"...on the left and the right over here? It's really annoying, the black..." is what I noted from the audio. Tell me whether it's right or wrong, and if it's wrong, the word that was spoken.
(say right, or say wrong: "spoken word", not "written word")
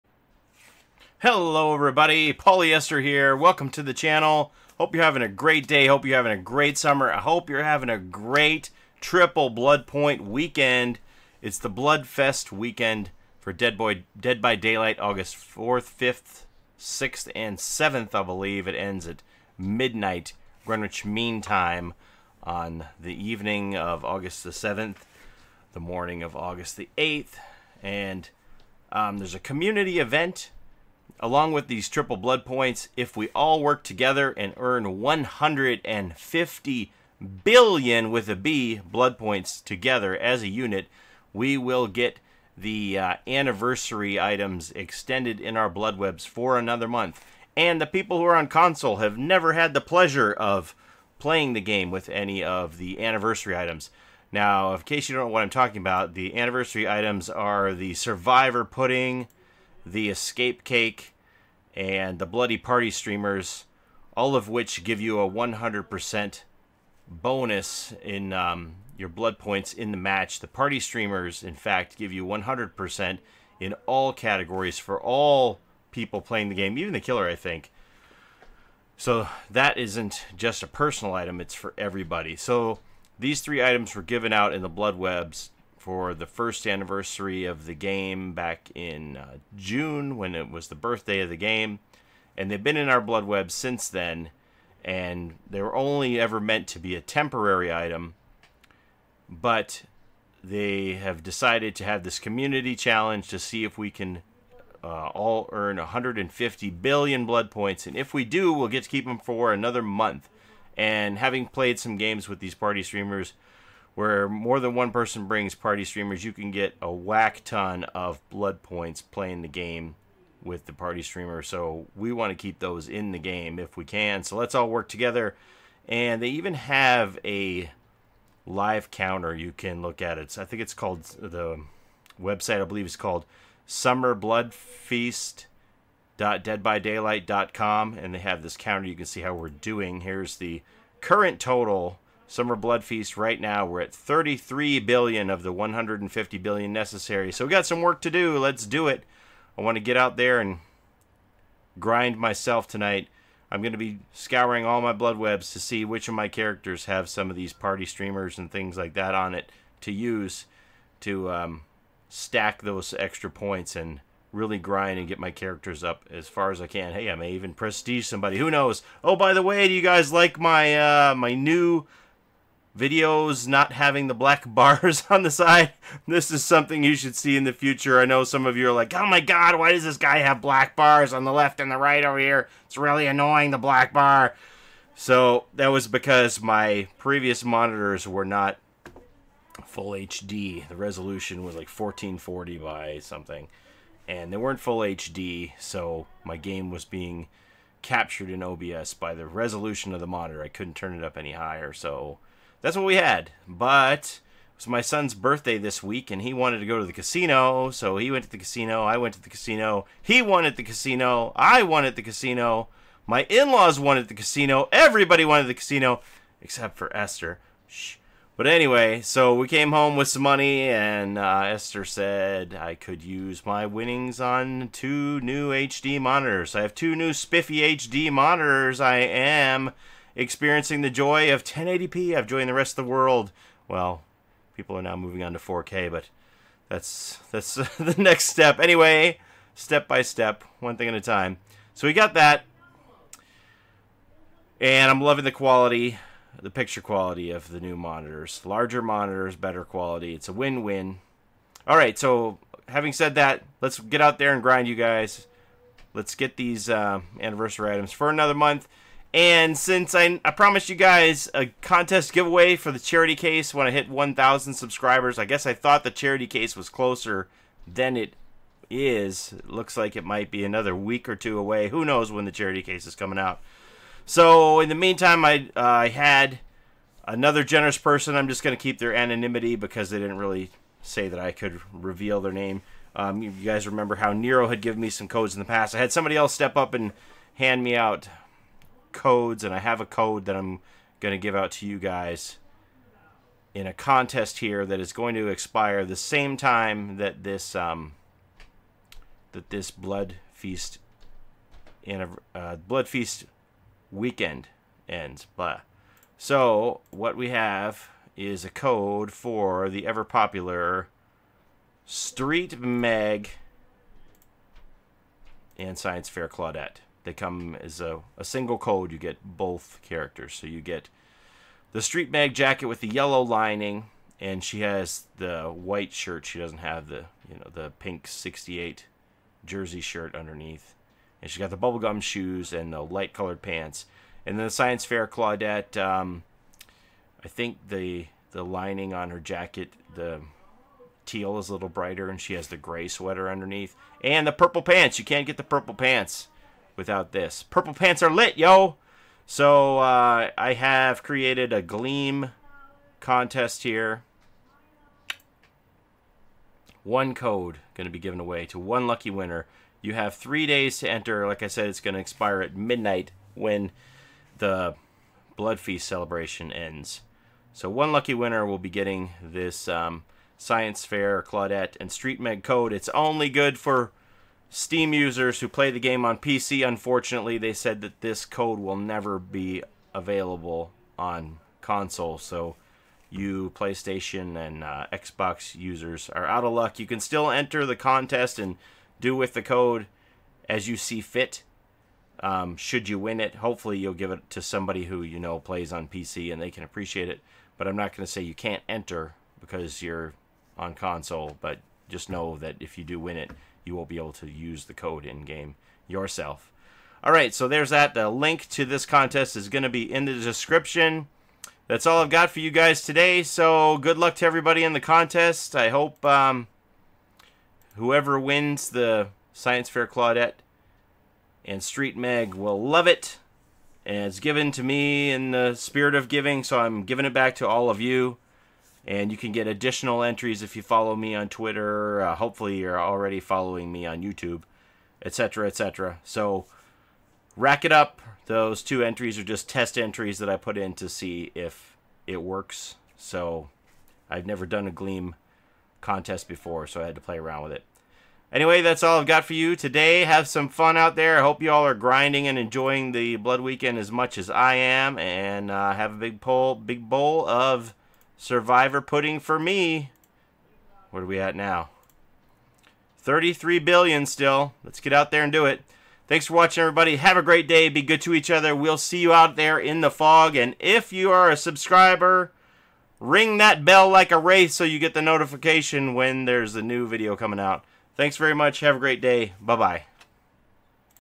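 right.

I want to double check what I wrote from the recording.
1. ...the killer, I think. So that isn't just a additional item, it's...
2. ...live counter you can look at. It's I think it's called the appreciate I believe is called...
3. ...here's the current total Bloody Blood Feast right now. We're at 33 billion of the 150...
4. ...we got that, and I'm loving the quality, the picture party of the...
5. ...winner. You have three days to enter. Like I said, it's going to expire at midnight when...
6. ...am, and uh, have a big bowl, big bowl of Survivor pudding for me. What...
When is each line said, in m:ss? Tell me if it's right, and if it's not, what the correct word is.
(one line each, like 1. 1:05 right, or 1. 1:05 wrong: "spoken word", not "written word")
1. 1:16 wrong: "personal", not "additional"
2. 2:08 wrong: "website", not "appreciate"
3. 2:20 wrong: "Summer", not "Bloody"
4. 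4:01 wrong: "quality", not "party"
5. 5:59 right
6. 7:34 right.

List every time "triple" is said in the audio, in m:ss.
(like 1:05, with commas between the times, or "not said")
0:09, 0:31.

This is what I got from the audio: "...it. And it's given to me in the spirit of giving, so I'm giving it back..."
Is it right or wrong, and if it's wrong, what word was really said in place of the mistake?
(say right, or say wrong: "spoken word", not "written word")
right.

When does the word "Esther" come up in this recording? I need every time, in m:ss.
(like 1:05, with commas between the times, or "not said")
0:02, 3:36, 3:41.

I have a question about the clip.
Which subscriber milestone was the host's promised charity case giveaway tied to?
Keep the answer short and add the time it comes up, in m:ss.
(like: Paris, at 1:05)
1,000 subscribers, at 4:23.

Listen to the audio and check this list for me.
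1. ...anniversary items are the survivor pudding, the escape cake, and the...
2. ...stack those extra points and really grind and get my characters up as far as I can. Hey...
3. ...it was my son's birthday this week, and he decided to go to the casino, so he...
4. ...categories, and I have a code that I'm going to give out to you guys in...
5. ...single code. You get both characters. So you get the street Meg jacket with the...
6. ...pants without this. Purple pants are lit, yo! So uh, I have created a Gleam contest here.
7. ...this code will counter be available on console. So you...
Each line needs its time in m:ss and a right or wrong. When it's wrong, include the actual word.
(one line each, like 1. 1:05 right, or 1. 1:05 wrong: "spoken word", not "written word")
1. 0:56 right
2. 2:42 right
3. 3:24 wrong: "wanted", not "decided"
4. 4:48 wrong: "codes", not "categories"
5. 5:18 right
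6. 5:45 right
7. 6:18 wrong: "never", not "counter".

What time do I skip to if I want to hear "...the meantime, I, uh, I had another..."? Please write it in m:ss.
4:34.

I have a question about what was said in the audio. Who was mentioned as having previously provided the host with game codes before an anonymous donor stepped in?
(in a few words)
Nero.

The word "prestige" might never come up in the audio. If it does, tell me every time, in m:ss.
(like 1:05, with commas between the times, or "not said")
2:47.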